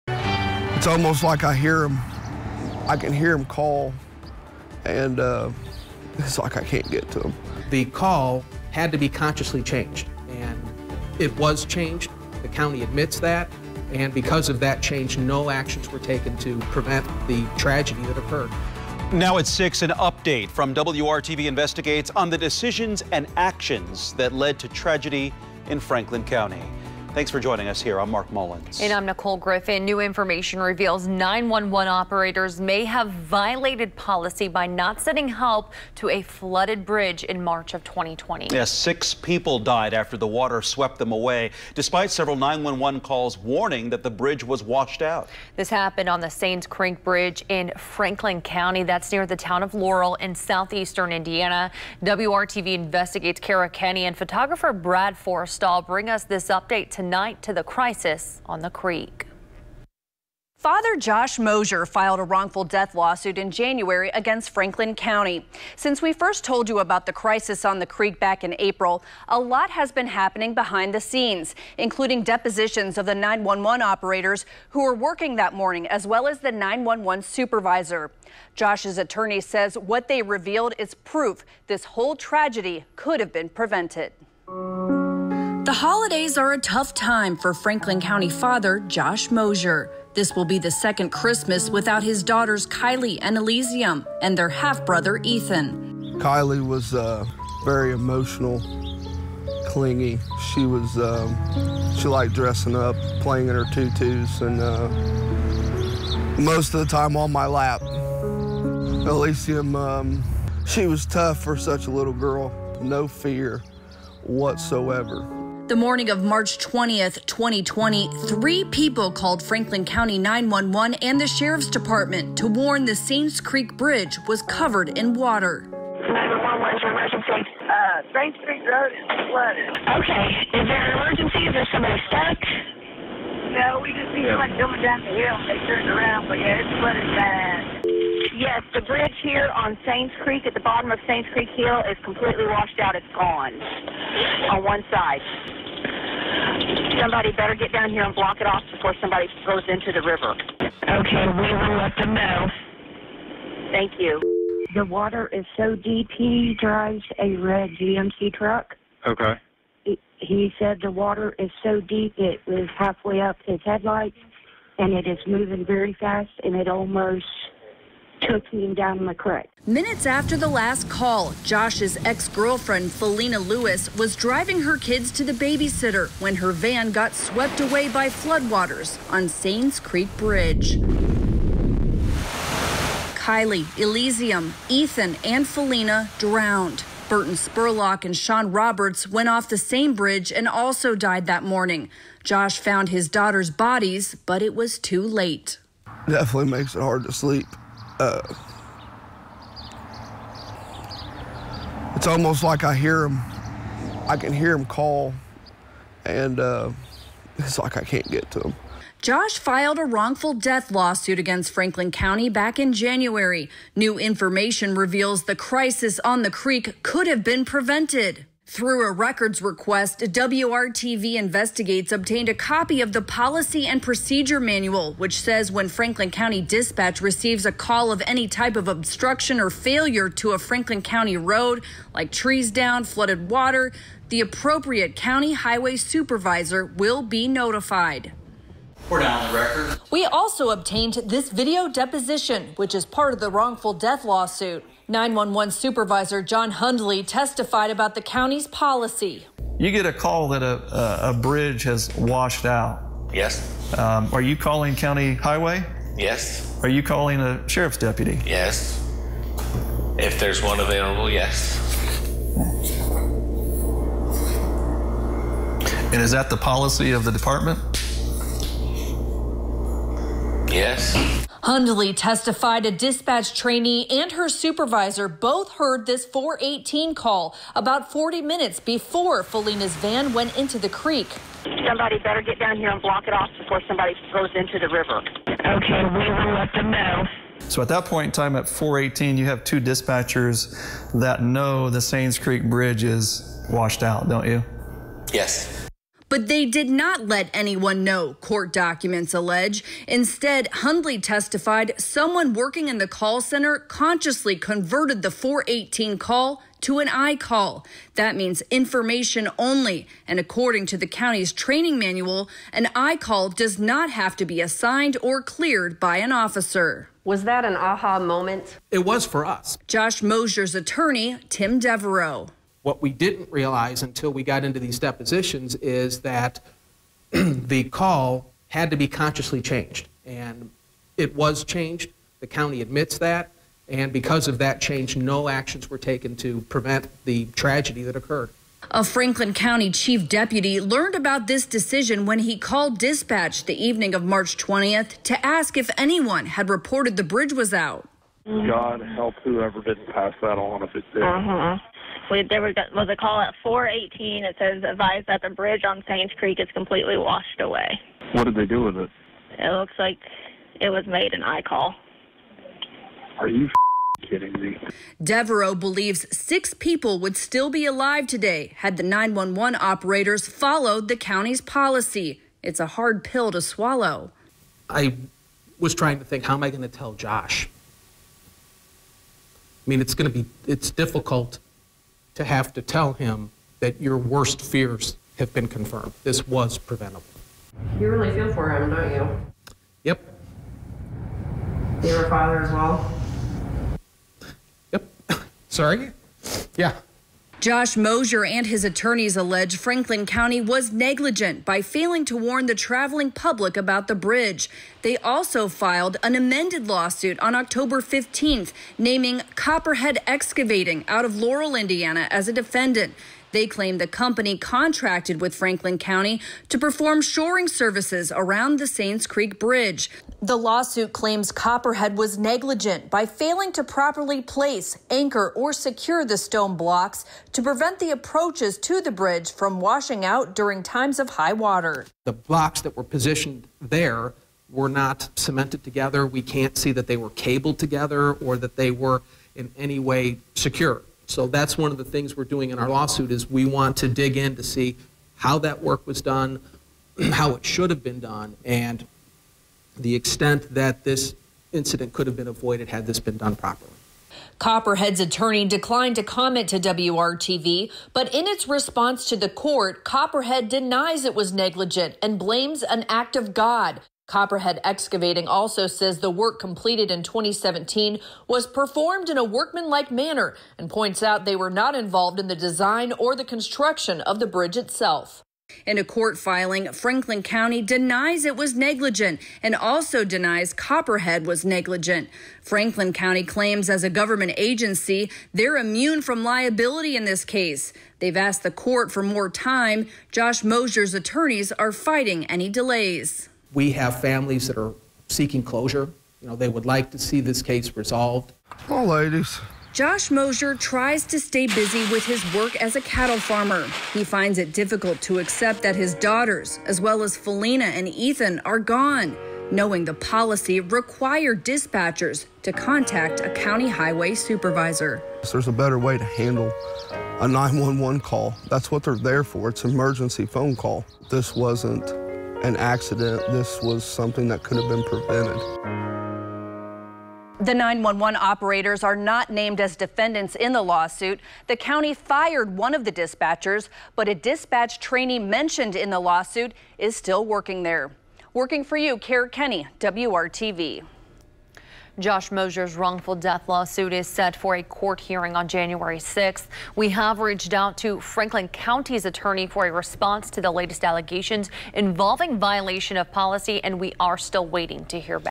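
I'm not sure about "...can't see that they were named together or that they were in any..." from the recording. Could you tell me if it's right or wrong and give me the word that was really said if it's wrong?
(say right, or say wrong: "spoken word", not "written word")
wrong: "cabled", not "named".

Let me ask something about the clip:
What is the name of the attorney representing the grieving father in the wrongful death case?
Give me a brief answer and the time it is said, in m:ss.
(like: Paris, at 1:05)
Tim Devereaux, at 5:21.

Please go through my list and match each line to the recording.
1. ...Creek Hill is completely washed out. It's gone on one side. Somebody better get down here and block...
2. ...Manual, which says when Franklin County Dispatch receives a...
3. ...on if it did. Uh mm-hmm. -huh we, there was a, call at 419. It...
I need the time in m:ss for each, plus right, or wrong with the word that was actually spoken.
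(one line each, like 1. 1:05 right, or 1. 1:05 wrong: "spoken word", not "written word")
1. 2:21 right
2. 3:44 right
3. 5:50 wrong: "418", not "419".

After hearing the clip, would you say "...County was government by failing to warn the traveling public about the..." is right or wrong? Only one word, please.
wrong.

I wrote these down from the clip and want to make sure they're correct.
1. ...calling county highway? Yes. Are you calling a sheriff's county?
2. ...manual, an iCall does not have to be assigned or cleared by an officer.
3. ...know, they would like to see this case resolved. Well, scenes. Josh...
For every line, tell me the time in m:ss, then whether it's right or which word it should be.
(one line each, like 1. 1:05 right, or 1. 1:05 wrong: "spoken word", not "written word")
1. 4:14 wrong: "deputy", not "county"
2. 5:11 right
3. 8:16 wrong: "ladies", not "scenes".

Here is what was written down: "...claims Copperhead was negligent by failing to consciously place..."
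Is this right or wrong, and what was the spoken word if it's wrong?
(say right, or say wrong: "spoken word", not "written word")
wrong: "properly", not "consciously".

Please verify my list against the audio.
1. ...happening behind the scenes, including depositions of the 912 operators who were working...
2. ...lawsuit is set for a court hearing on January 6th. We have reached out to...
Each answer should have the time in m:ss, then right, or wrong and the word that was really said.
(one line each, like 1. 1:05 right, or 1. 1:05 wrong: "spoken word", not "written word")
1. 1:10 wrong: "911", not "912"
2. 9:03 right.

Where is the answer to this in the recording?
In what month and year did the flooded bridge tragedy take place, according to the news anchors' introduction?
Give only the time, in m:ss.
0:37.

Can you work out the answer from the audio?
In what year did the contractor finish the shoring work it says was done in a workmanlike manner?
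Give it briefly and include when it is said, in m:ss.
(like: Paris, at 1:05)
2017, at 7:47.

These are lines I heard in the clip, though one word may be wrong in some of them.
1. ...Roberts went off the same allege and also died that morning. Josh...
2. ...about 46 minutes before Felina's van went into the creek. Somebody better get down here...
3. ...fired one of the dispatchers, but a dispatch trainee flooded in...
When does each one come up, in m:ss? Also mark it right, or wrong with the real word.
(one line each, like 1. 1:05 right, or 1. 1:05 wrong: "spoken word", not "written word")
1. 3:08 wrong: "bridge", not "allege"
2. 4:37 wrong: "40", not "46"
3. 8:51 wrong: "mentioned", not "flooded".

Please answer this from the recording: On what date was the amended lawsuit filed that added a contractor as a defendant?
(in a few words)
October 15.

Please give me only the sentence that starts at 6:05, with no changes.
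Devereaux believes six people would still be alive today had the 911 operators followed the county's policy.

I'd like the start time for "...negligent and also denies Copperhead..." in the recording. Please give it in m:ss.
7:58.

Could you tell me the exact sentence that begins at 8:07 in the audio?
They've asked the court for more time.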